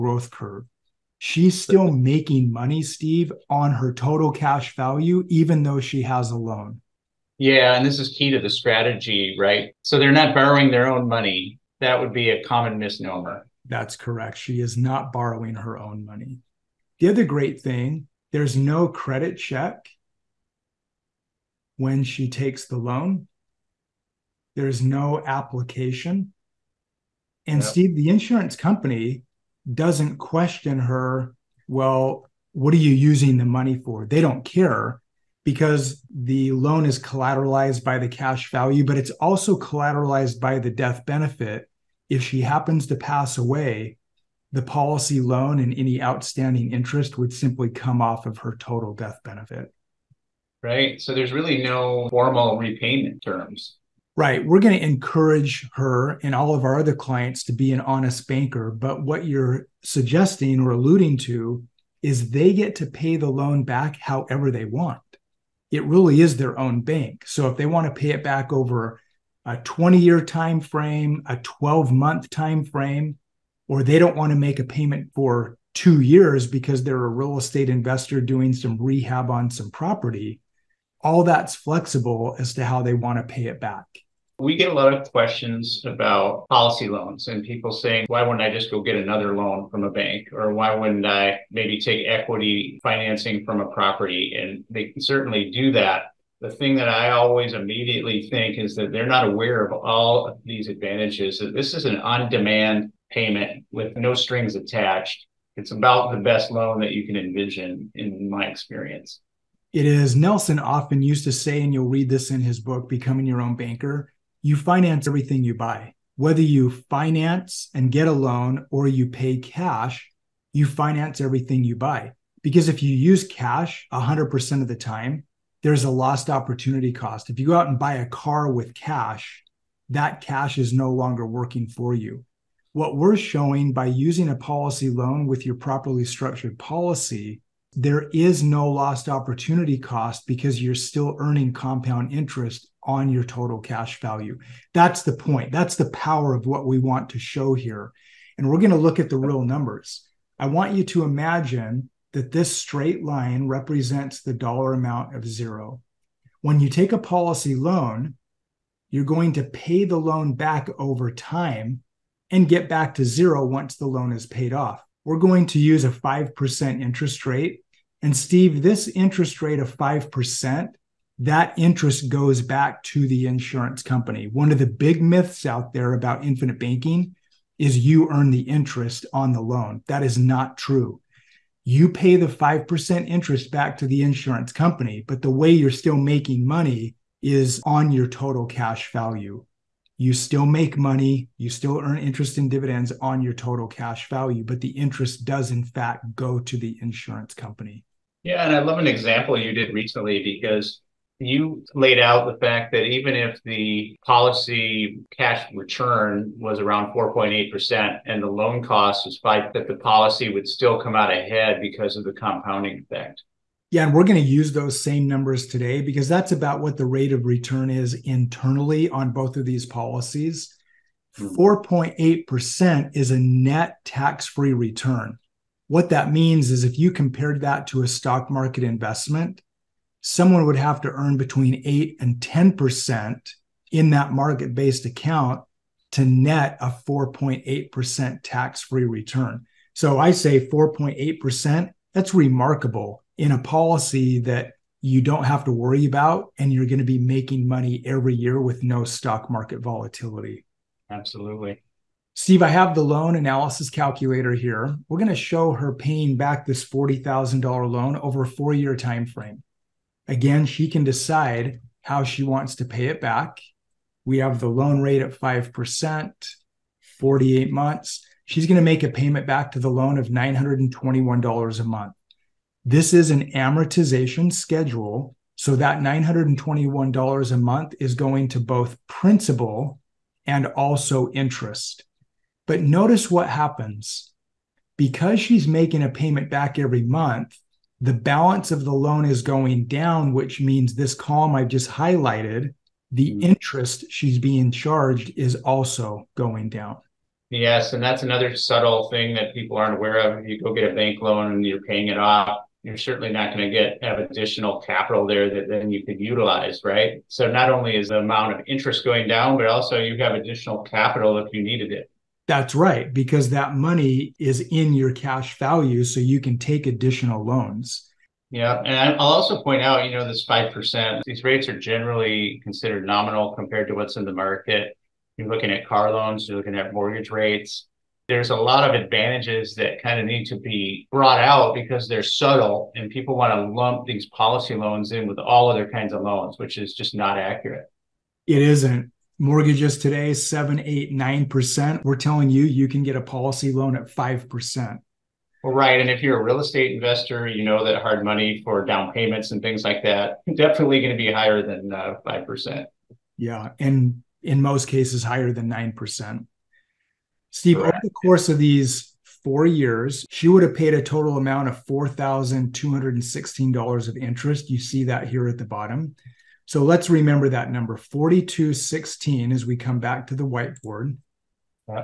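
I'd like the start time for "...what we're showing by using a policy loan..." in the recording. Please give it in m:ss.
2:12.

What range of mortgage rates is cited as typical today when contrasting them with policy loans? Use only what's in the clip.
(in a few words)
7 to 9 percent.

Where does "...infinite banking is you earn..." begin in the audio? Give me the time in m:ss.
2:56.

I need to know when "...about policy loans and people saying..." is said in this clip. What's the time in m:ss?
1:25.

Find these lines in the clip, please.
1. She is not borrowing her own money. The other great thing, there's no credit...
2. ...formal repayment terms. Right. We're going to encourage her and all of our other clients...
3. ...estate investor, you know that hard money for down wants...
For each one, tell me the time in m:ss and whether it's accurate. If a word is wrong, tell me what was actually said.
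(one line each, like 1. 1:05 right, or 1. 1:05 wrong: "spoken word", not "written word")
1. 0:14 right
2. 0:52 right
3. 5:46 wrong: "payments", not "wants".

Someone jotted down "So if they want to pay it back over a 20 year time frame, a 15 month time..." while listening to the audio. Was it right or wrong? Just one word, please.
wrong.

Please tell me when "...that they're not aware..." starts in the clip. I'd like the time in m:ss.
1:38.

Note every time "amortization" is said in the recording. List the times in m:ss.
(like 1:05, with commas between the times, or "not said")
4:33.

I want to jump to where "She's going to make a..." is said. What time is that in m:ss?
4:28.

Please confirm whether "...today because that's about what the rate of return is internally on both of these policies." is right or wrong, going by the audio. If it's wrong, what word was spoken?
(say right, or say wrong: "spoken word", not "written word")
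right.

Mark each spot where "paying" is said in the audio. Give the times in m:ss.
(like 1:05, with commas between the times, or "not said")
4:15, 5:01.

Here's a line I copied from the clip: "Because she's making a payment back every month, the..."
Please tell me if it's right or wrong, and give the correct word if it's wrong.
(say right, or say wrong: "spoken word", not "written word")
right.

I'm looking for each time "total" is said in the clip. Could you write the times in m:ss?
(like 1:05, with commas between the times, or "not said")
0:03, 0:48, 2:23, 3:08, 3:13, 6:00.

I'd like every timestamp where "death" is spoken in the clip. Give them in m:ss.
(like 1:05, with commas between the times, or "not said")
0:40, 0:48.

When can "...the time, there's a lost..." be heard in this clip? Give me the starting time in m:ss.
2:04.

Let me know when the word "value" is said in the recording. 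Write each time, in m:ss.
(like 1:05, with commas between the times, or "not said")
0:04, 0:38, 2:23, 3:08, 3:14, 5:15.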